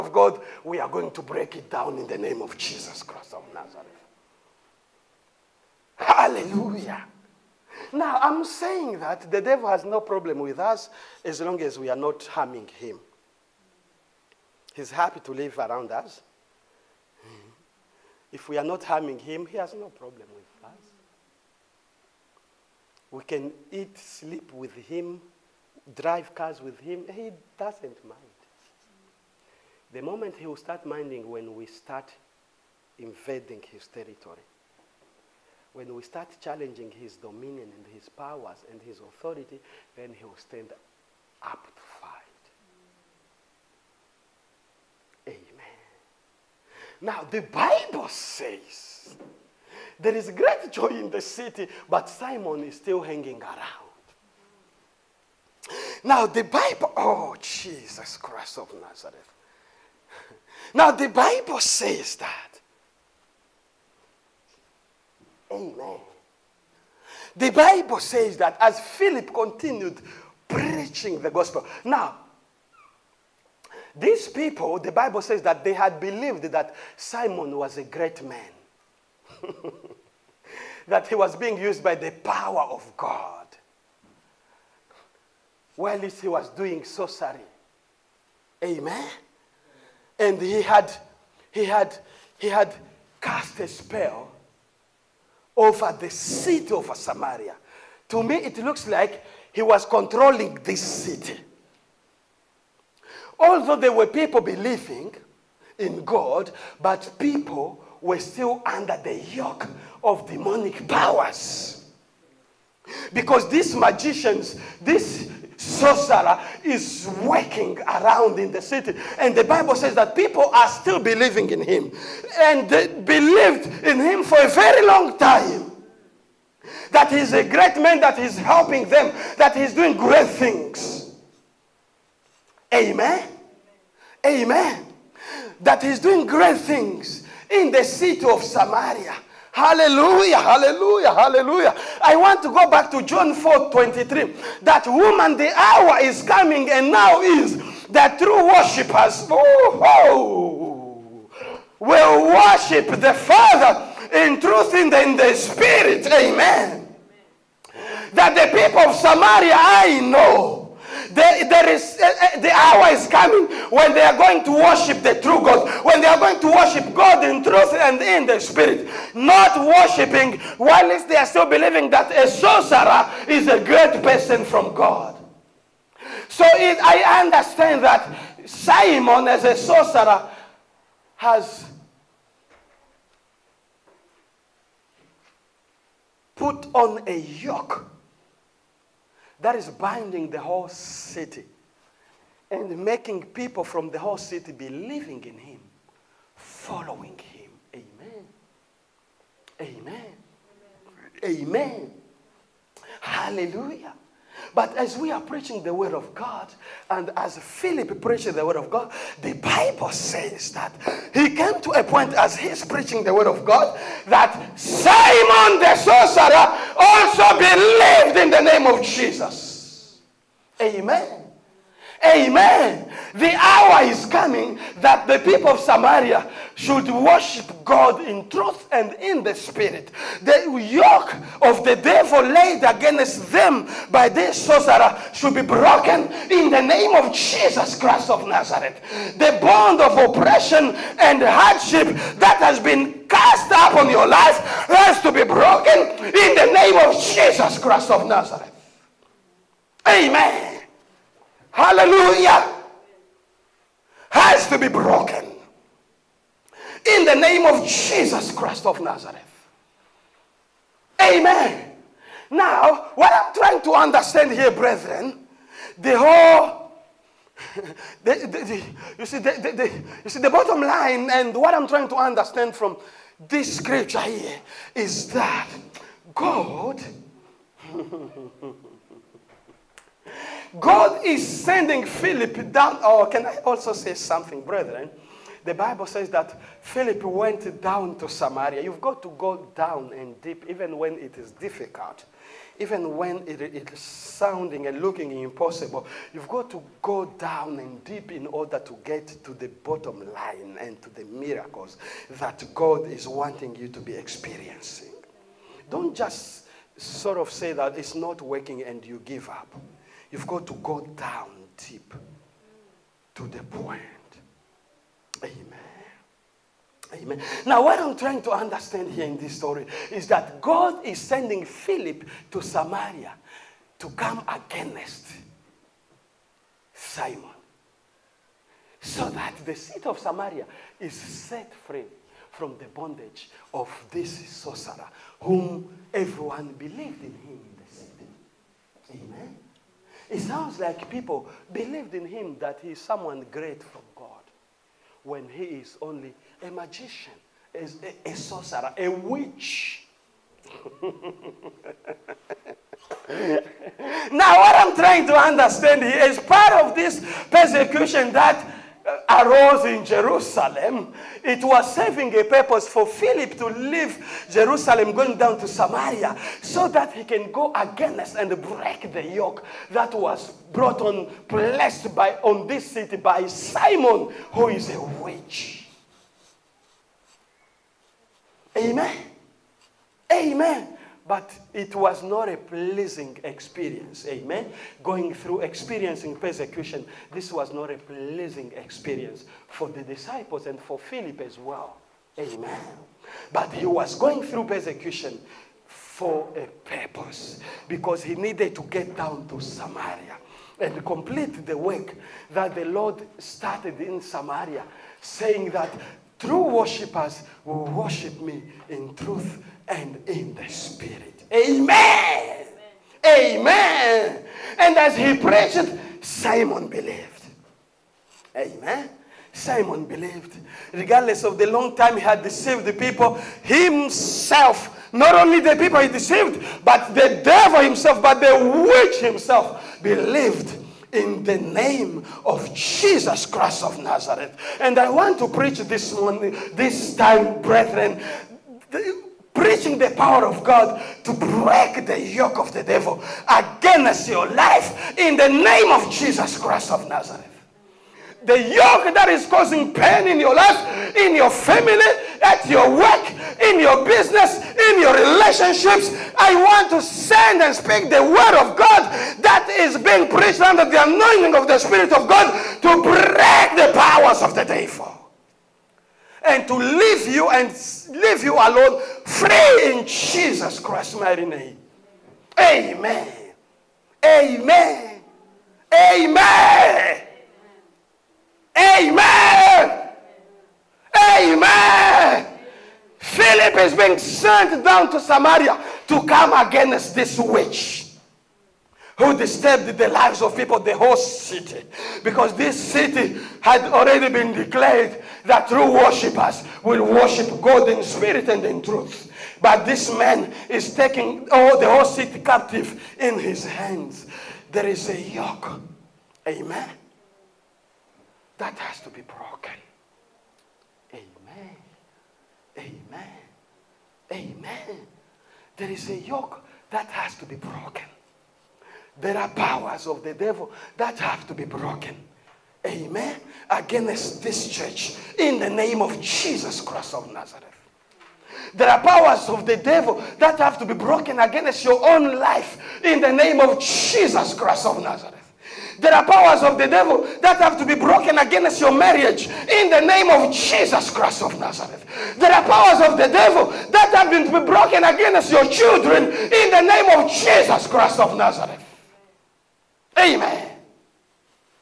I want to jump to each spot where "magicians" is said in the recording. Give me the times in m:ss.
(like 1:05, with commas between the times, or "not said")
1:53, 5:46.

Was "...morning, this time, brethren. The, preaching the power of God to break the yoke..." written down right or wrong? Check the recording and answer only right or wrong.
right.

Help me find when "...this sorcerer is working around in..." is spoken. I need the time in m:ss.
1:54.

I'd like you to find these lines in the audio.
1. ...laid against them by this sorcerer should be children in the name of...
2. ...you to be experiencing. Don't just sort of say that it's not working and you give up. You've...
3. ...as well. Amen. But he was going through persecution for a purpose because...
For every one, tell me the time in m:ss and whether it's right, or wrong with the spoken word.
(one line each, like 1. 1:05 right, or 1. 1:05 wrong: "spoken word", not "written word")
1. 3:52 wrong: "broken", not "children"
2. 5:03 right
3. 6:31 right.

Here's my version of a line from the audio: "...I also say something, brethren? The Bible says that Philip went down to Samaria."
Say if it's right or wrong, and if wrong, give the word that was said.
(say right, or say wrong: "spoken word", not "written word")
right.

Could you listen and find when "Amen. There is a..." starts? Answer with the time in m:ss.
8:34.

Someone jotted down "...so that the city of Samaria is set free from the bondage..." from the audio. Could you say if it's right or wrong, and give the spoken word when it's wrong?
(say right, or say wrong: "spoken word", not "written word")
right.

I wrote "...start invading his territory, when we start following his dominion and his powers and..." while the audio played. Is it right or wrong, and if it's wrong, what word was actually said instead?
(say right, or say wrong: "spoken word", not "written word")
wrong: "challenging", not "following".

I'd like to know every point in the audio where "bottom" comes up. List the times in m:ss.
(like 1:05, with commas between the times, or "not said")
4:30, 4:59.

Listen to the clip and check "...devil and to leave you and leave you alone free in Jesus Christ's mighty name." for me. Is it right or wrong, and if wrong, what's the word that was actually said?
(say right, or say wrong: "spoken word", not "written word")
right.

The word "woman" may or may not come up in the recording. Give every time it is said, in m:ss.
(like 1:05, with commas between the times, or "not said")
2:24.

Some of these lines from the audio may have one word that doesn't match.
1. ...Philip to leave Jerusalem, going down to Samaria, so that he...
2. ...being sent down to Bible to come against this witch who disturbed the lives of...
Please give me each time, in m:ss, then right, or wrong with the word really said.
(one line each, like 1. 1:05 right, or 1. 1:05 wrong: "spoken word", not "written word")
1. 6:02 right
2. 8:03 wrong: "Samaria", not "Bible".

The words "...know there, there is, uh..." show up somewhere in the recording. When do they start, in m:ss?
2:40.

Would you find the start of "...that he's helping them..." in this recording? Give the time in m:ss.
2:08.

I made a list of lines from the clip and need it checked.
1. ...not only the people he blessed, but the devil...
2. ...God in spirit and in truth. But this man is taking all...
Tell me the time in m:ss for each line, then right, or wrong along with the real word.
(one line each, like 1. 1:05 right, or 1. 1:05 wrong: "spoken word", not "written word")
1. 7:04 wrong: "deceived", not "blessed"
2. 8:17 right.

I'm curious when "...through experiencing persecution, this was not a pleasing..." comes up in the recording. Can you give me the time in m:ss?
6:25.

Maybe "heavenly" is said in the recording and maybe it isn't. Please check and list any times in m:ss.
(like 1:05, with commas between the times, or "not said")
not said.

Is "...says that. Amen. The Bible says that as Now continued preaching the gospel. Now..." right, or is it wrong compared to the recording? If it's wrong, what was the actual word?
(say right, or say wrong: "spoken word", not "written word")
wrong: "Philip", not "Now".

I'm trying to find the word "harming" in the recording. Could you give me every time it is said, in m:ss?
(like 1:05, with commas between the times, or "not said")
0:12, 0:18.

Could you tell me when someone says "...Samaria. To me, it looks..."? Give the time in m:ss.
1:36.